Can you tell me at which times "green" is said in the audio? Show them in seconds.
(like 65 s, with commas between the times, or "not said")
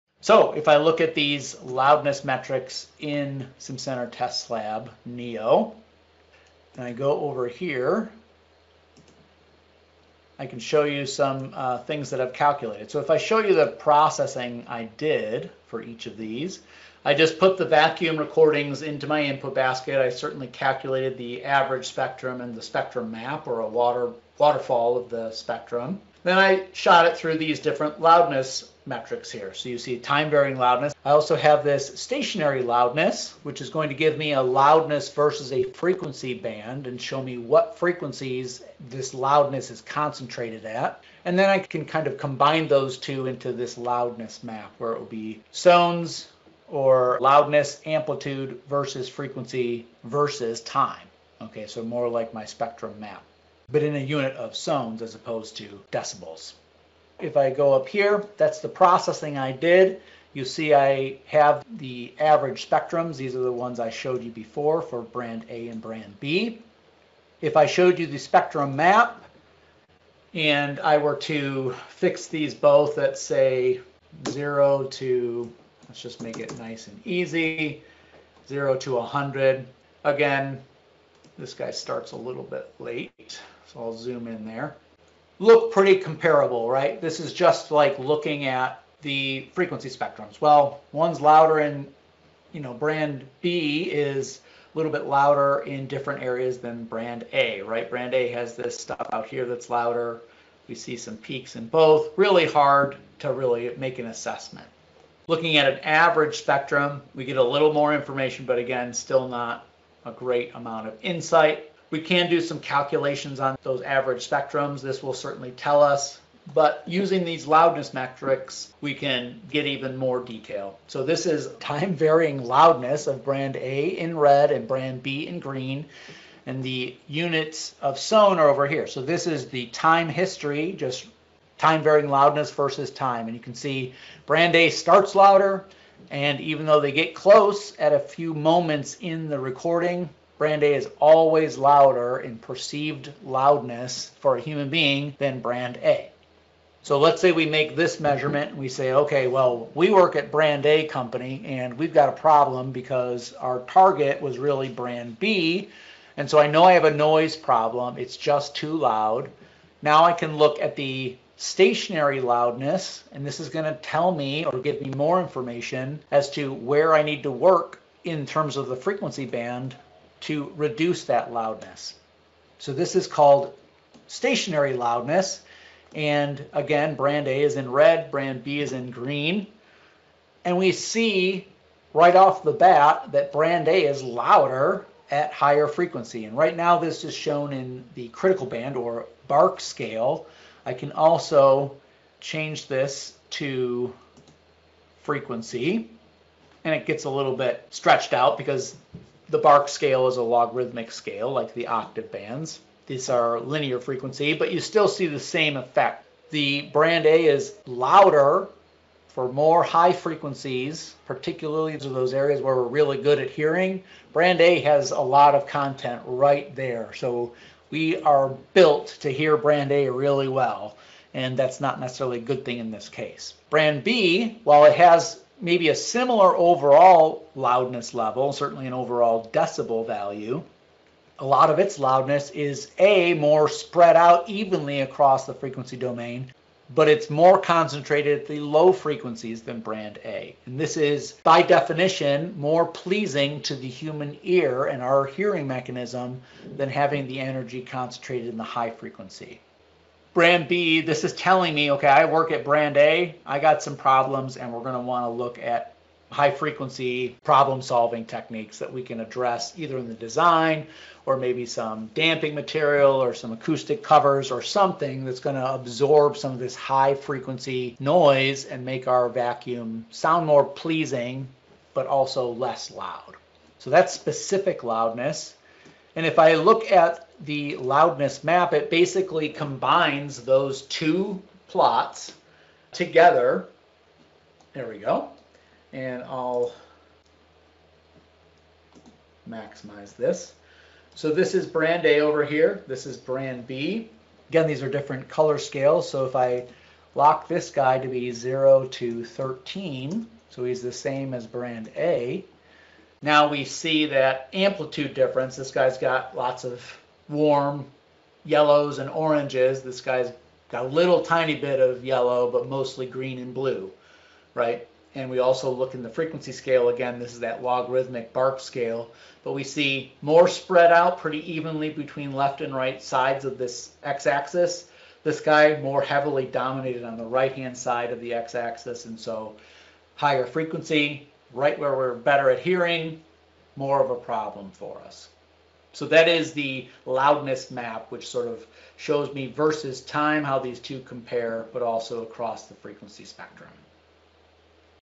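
125 s, 178 s, 312 s.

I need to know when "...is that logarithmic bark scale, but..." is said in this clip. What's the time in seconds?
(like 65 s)
317 s.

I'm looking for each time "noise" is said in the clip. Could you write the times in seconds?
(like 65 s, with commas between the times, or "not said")
156 s, 267 s.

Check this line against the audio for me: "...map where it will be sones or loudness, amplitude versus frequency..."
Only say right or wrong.
right.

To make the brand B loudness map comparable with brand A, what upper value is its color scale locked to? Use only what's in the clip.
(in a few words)
13.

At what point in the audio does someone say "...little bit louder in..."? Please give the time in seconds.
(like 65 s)
94 s.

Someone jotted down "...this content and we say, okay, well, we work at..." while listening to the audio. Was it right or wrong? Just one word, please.
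wrong.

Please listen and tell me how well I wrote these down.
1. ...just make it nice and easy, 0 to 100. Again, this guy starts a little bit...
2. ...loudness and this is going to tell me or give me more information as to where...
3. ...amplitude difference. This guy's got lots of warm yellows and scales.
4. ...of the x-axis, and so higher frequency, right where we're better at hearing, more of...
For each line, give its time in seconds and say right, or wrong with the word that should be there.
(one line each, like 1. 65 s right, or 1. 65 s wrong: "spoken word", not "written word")
1. 76 s right
2. 162 s right
3. 304 s wrong: "oranges", not "scales"
4. 327 s right.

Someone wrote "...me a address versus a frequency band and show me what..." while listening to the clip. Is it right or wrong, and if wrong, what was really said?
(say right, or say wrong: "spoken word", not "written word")
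wrong: "loudness", not "address".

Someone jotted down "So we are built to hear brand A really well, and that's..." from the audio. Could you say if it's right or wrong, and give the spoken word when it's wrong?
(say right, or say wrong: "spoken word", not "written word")
right.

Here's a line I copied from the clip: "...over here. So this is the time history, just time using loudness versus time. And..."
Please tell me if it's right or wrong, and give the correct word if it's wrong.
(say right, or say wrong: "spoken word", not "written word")
wrong: "varying", not "using".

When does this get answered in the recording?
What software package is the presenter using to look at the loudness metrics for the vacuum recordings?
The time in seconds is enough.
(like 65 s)
3 s.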